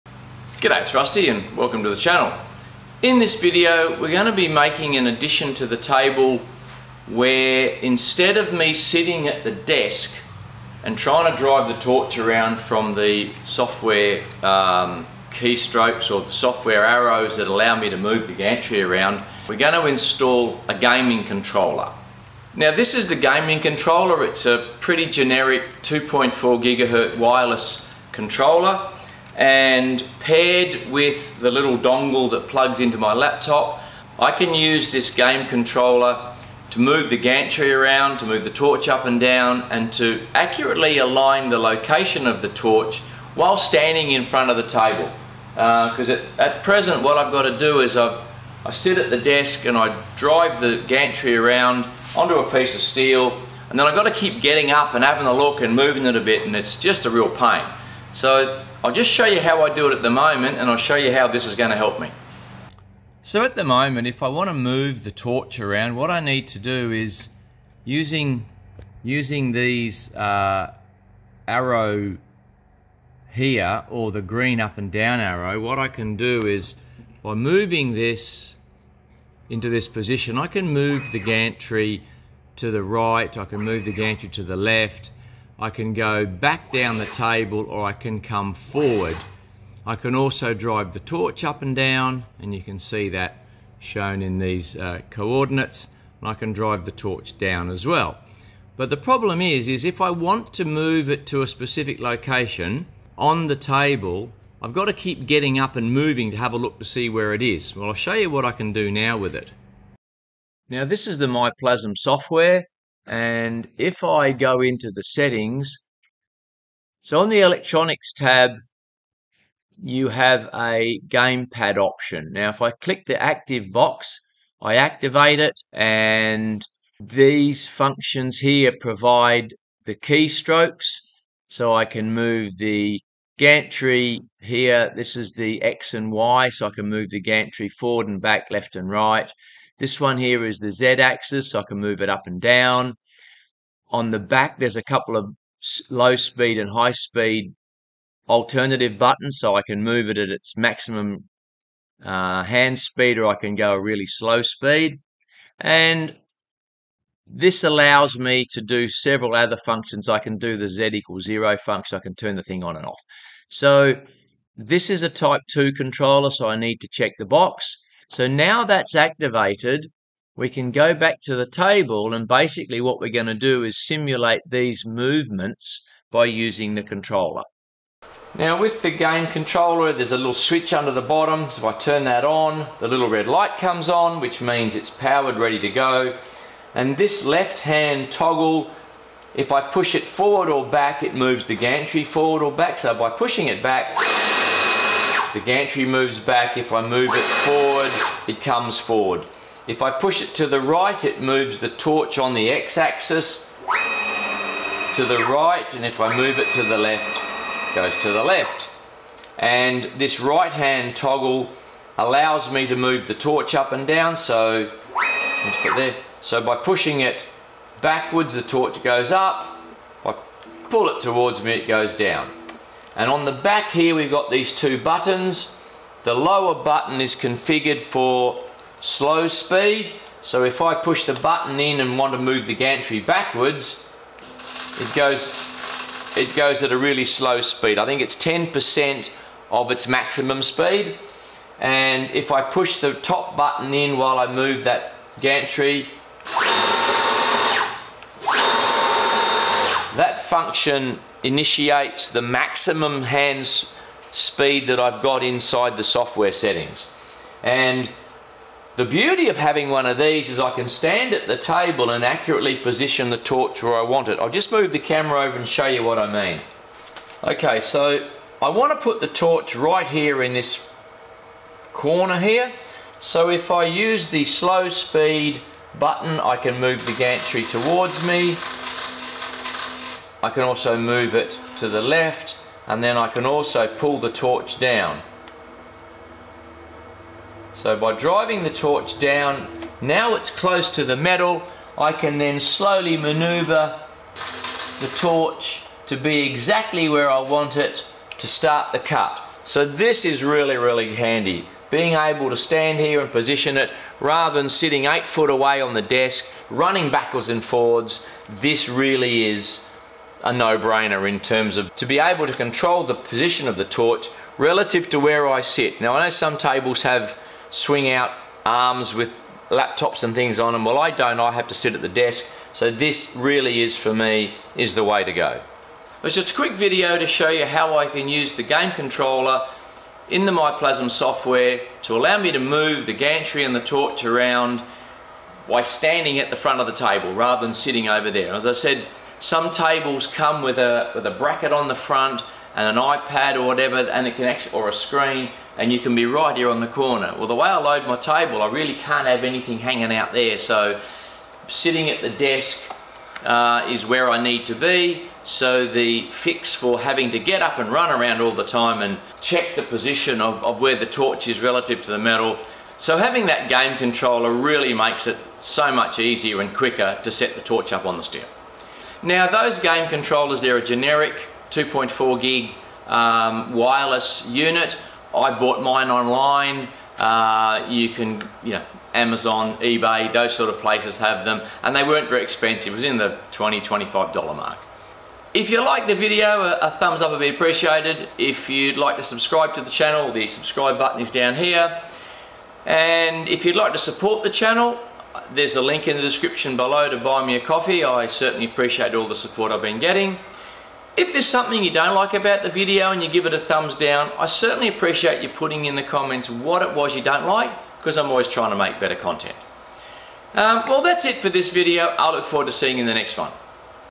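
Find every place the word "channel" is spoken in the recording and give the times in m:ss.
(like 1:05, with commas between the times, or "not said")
0:01, 6:29, 6:34.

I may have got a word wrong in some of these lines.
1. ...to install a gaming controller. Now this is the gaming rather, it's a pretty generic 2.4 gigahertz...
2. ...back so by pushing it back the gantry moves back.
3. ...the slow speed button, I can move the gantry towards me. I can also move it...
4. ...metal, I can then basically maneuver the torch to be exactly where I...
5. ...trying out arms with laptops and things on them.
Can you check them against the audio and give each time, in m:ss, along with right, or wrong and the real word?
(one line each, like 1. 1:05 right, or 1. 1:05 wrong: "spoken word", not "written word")
1. 0:19 wrong: "controller", not "rather"
2. 3:12 right
3. 4:34 right
4. 4:50 wrong: "slowly", not "basically"
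5. 5:17 wrong: "swing", not "trying".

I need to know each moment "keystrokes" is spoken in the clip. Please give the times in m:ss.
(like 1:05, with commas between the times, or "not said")
0:15, 2:09.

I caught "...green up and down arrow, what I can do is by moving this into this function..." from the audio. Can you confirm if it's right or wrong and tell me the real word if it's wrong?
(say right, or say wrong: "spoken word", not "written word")
wrong: "position", not "function".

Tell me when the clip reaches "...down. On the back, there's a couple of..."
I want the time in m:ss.
2:22.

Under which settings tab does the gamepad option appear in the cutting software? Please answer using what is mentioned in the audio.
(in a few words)
Electronics.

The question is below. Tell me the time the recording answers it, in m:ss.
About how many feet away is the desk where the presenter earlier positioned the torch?
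5:04.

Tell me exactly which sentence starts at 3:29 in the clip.
And this right-hand toggle allows me to move the torch up and down, so there.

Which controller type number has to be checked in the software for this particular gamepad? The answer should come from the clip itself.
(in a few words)
Type 2.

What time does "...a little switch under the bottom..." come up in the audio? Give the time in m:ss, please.
3:00.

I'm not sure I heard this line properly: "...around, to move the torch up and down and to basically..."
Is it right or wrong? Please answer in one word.
wrong.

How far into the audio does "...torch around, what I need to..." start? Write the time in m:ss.
1:05.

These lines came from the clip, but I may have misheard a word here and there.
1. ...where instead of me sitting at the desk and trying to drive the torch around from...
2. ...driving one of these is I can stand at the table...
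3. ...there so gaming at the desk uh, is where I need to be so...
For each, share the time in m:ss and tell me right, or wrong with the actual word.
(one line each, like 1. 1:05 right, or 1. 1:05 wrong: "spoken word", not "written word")
1. 0:07 right
2. 4:19 wrong: "having", not "driving"
3. 5:50 wrong: "sitting", not "gaming".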